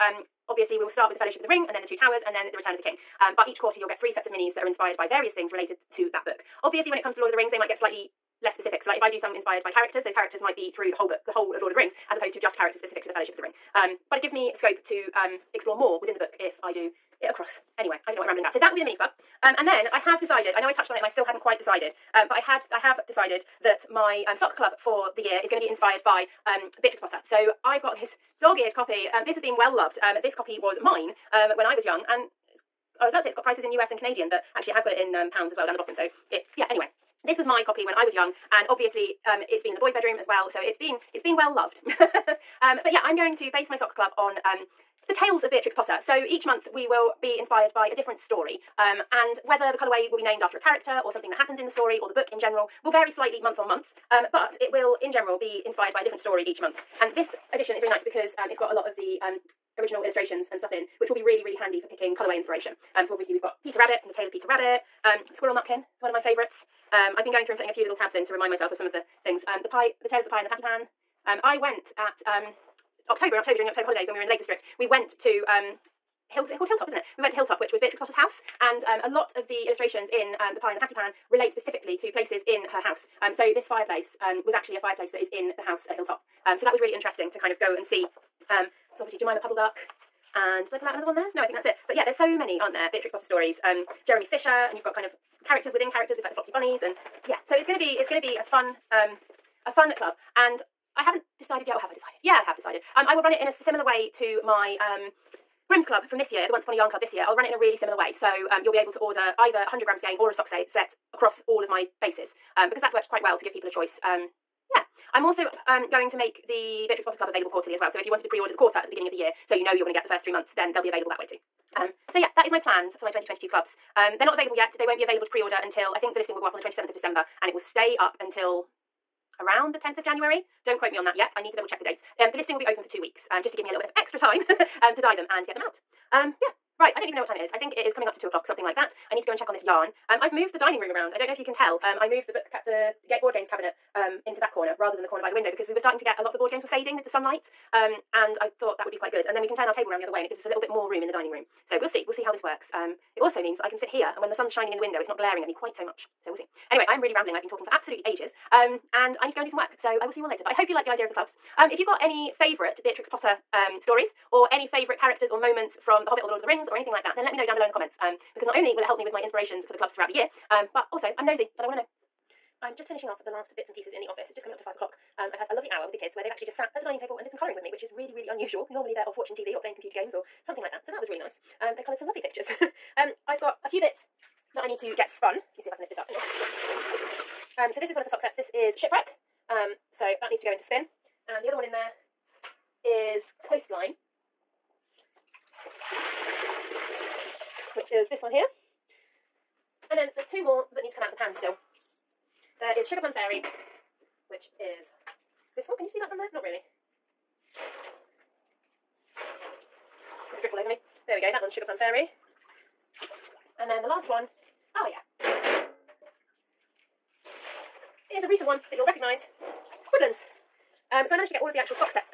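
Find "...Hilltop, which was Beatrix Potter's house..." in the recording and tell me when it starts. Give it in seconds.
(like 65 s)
77 s.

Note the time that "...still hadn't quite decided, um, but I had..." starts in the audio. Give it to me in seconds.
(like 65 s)
21 s.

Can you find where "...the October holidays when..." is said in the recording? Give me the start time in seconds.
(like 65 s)
73 s.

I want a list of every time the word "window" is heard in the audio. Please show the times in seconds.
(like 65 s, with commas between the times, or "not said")
145 s, 154 s.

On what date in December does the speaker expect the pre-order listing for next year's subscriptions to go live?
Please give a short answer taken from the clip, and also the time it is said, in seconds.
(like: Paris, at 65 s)
27th of December, at 126 s.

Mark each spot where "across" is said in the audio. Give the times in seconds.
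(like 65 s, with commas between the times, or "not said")
17 s, 111 s.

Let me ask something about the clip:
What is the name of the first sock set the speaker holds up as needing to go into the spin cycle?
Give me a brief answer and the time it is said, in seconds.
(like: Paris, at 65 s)
Shipwreck, at 188 s.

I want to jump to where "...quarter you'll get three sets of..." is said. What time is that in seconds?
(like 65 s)
3 s.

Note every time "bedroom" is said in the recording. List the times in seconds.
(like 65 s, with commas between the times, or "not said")
39 s.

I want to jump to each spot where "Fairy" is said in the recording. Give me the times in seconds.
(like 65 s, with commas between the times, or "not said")
203 s, 211 s.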